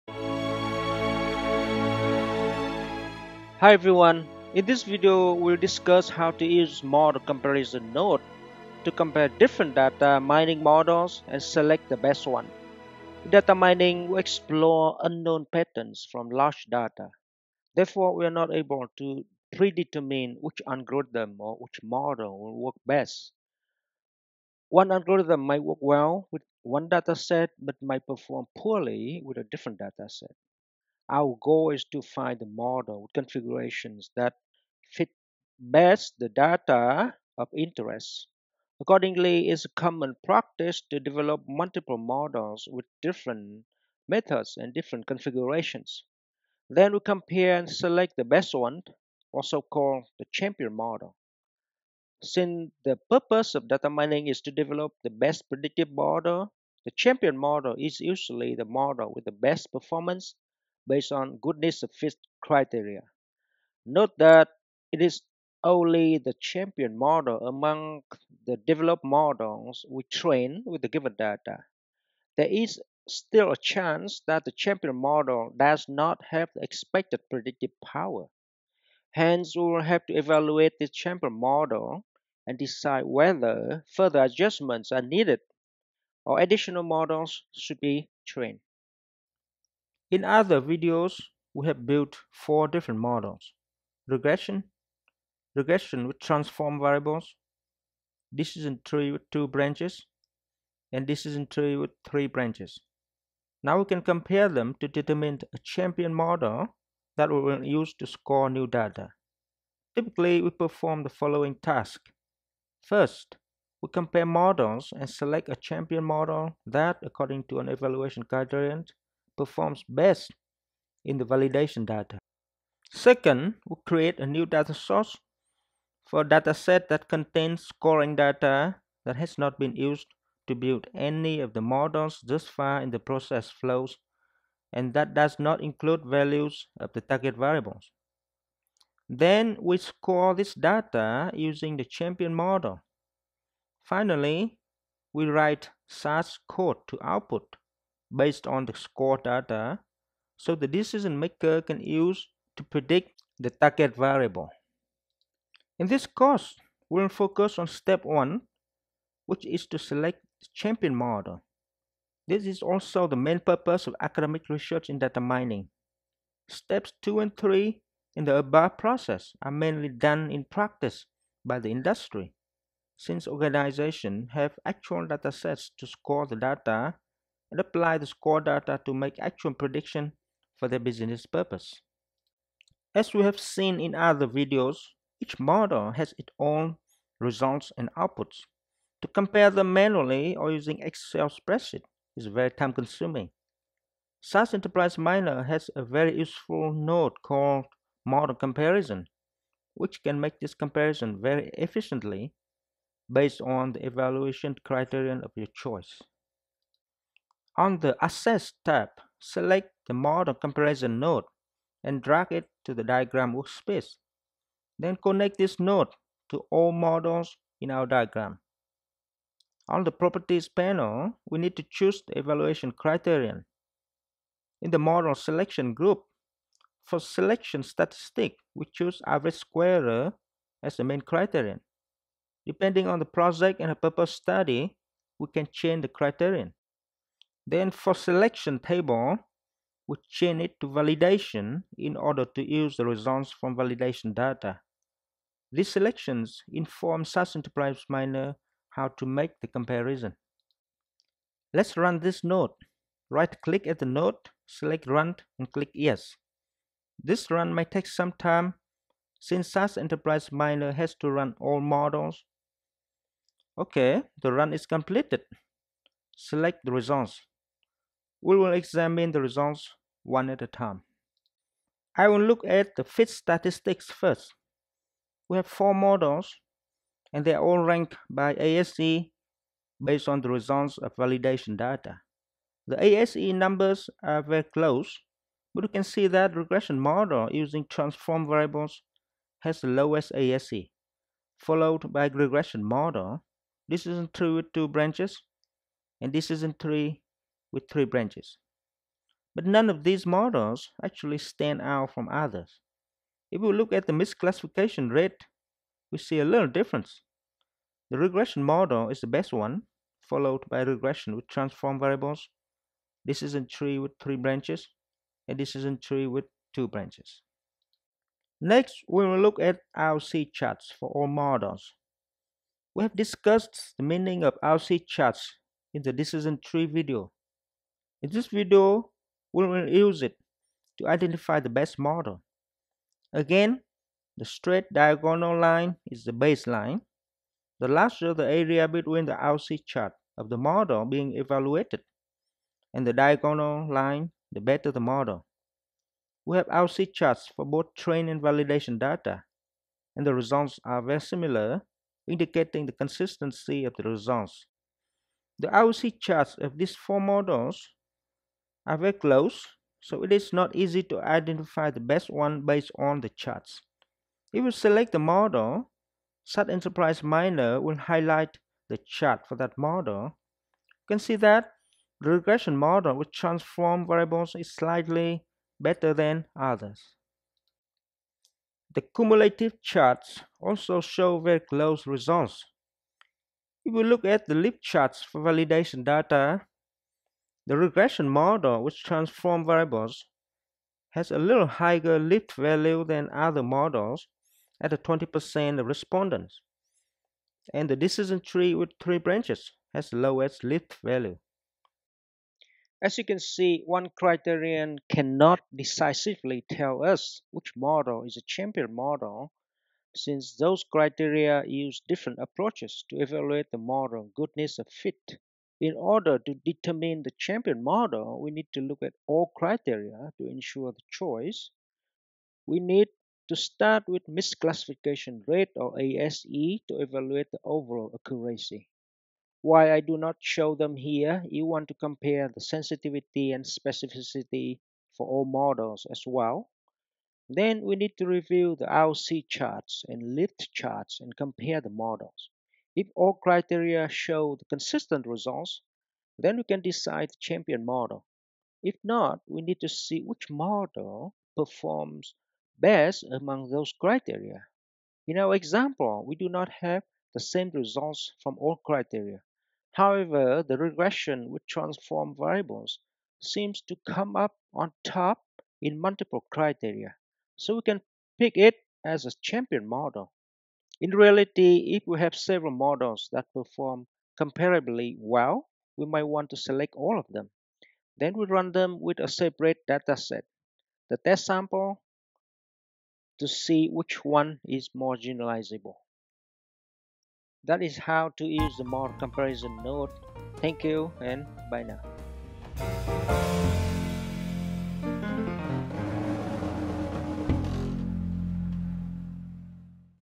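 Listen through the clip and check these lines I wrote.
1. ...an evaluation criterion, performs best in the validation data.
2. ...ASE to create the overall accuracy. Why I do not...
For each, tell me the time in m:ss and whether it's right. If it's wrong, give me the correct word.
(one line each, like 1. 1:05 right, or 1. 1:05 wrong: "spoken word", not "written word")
1. 1:57 right
2. 7:05 wrong: "evaluate", not "create".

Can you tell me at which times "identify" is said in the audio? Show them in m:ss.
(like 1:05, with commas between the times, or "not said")
5:30, 6:01.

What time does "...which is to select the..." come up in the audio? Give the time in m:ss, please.
2:39.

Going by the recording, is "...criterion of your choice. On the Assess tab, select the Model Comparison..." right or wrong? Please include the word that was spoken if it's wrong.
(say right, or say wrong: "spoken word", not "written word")
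right.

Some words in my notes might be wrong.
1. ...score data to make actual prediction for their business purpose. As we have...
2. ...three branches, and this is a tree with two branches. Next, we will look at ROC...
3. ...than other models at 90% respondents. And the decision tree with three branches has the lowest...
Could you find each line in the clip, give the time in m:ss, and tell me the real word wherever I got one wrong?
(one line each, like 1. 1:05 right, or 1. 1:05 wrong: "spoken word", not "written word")
1. 2:58 right
2. 5:14 right
3. 6:32 wrong: "20", not "90".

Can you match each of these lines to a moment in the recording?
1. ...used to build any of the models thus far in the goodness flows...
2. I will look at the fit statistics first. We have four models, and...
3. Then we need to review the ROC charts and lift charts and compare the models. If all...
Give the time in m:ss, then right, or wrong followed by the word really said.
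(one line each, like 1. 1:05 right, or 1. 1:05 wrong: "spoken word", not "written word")
1. 2:09 wrong: "process", not "goodness"
2. 4:31 right
3. 7:17 right.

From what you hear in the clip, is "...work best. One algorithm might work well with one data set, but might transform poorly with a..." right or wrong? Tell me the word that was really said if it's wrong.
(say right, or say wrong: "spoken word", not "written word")
wrong: "perform", not "transform".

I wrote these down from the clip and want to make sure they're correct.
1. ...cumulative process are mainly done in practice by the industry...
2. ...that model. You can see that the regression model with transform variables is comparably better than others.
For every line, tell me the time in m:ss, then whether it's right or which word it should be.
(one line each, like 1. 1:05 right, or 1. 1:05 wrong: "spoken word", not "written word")
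1. 2:48 wrong: "above", not "cumulative"
2. 6:09 wrong: "slightly", not "comparably".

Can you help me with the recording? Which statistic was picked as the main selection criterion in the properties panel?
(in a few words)
average square.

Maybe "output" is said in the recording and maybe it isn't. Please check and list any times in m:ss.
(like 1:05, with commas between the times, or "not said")
2:27, 3:07.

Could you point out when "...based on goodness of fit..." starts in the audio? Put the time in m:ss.
1:00.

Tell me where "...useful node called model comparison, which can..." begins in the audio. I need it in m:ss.
3:16.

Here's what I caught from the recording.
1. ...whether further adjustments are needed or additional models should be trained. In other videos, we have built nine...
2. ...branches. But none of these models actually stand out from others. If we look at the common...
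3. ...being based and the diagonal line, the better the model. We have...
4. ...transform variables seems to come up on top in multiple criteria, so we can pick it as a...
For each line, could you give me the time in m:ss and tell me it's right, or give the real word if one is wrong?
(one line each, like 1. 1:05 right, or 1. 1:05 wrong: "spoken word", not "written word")
1. 1:23 wrong: "four", not "nine"
2. 4:57 wrong: "misclassification", not "common"
3. 5:40 wrong: "evaluated", not "based"
4. 7:41 right.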